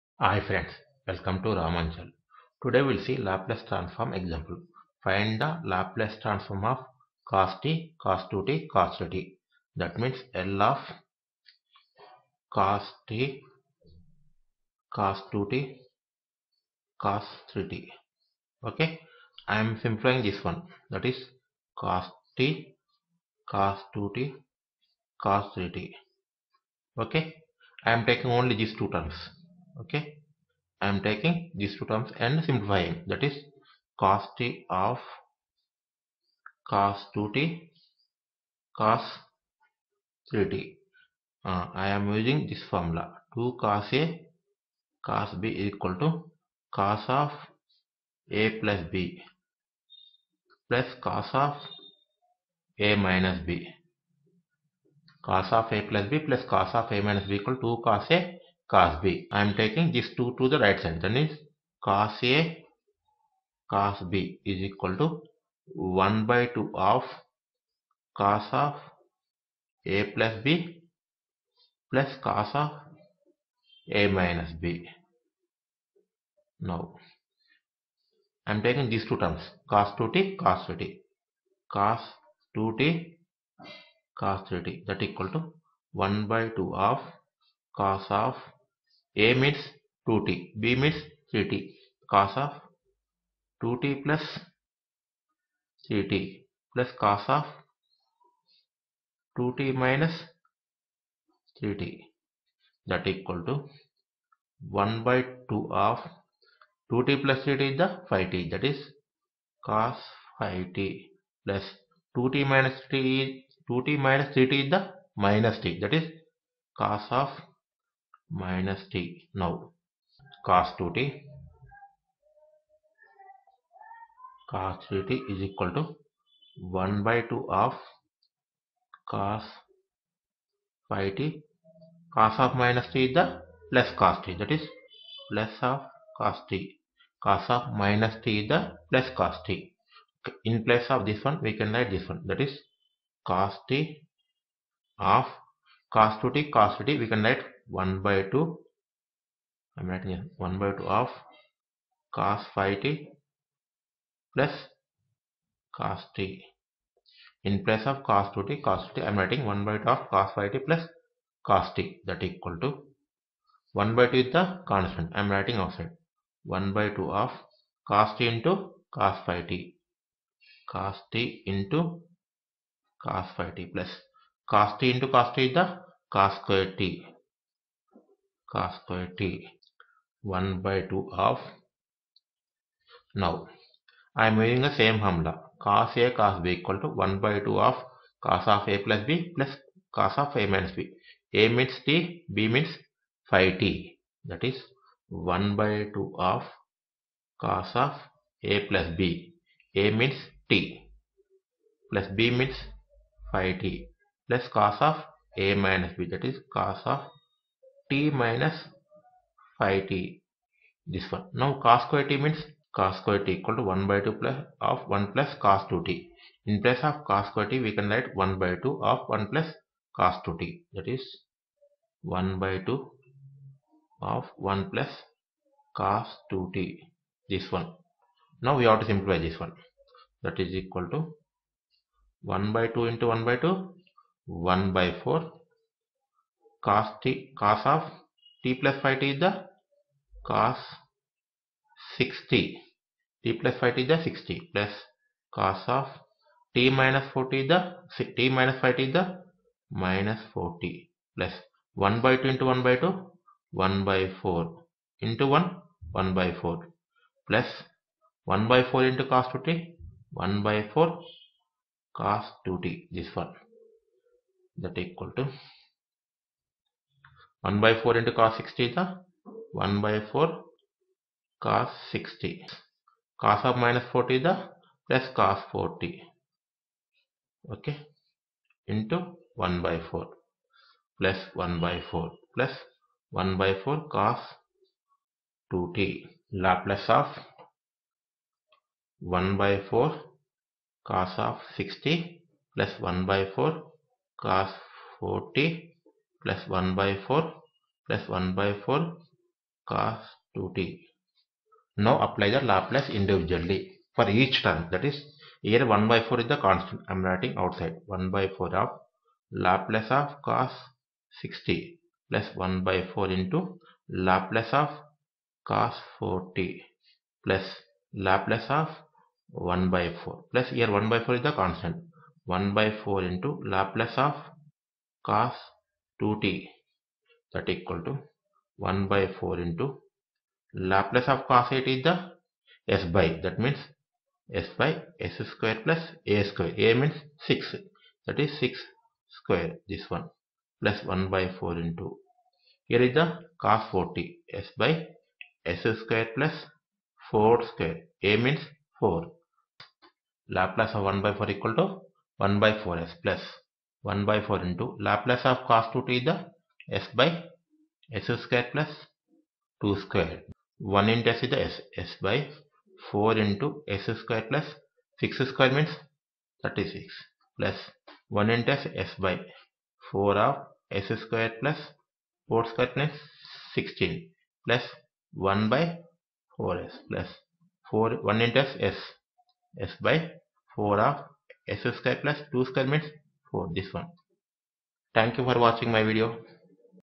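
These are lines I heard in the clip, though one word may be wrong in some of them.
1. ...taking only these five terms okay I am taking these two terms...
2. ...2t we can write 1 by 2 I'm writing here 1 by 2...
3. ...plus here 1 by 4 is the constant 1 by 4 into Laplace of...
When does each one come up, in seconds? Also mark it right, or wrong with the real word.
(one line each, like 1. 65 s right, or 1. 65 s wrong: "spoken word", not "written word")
1. 28 s wrong: "two", not "five"
2. 146 s right
3. 320 s right.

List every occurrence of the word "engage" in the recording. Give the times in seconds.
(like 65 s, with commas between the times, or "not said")
not said.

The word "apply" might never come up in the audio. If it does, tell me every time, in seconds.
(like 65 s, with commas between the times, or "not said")
302 s.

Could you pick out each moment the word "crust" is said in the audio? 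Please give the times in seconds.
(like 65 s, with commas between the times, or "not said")
not said.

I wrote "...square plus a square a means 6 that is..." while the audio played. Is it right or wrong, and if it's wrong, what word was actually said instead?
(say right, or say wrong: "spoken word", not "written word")
right.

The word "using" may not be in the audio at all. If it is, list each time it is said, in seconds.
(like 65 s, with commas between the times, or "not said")
42 s, 184 s.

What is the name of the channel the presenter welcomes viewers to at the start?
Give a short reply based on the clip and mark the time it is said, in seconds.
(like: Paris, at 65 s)
Ramanchal, at 1 s.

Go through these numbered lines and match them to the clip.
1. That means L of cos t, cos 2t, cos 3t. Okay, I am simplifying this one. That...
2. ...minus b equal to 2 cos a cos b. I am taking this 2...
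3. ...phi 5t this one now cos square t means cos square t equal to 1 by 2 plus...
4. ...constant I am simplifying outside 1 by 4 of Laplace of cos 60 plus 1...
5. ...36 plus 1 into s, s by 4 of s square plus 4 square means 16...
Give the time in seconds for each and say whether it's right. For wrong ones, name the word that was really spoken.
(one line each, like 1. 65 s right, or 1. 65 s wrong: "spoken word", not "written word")
1. 9 s right
2. 57 s right
3. 209 s right
4. 306 s wrong: "writing", not "simplifying"
5. 366 s right.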